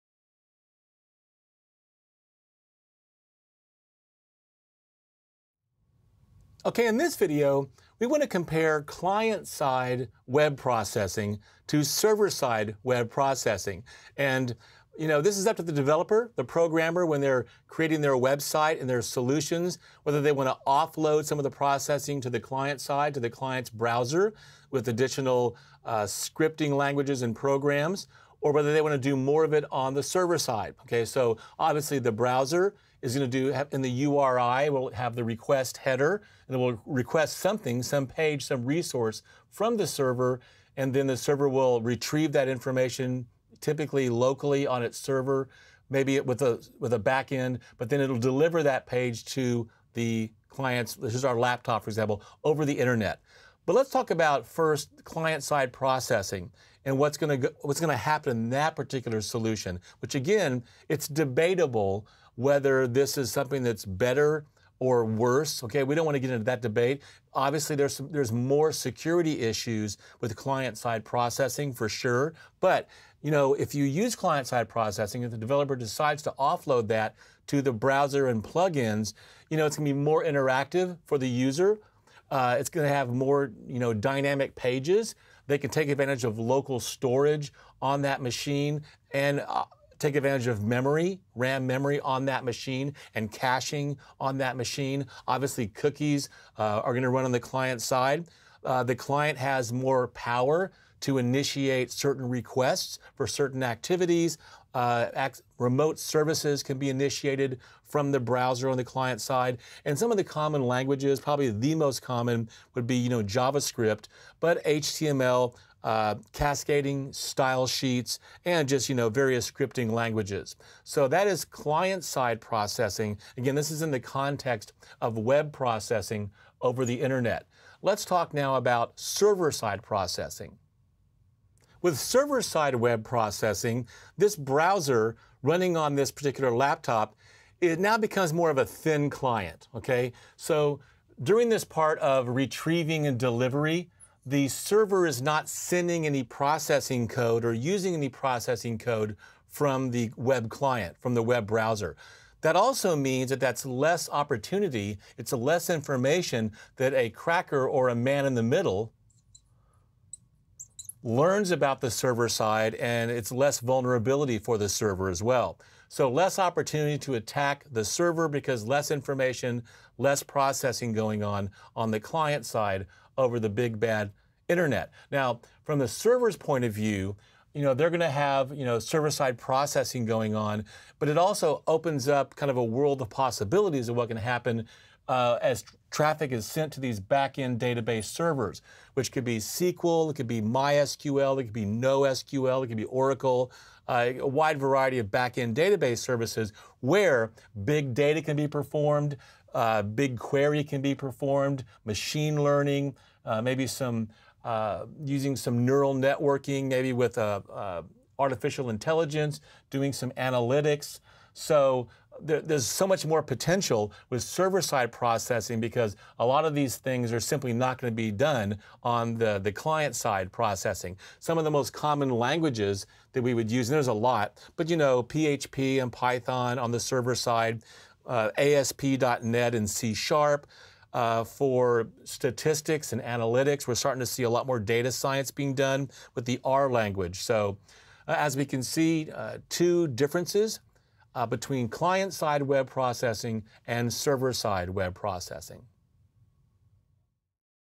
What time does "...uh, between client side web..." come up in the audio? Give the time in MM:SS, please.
04:01.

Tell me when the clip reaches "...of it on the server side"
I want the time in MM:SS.
00:29.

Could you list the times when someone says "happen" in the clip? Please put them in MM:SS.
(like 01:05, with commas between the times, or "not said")
00:57, 03:04.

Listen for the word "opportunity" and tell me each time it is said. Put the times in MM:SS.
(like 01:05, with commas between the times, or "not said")
02:34, 02:46.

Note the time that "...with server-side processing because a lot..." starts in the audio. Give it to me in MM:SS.
03:34.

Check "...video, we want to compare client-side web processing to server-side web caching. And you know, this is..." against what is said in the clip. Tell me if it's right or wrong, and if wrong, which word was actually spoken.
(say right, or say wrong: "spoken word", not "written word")
wrong: "processing", not "caching".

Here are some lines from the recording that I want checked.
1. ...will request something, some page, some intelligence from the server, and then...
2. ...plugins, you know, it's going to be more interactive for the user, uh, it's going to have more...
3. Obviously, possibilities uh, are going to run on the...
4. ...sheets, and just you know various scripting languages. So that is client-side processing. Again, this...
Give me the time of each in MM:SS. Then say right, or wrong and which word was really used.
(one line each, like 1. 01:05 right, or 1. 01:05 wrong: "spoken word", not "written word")
1. 00:36 wrong: "resource", not "intelligence"
2. 01:18 right
3. 01:35 wrong: "cookies", not "possibilities"
4. 01:57 right.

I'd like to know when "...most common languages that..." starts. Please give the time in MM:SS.
03:41.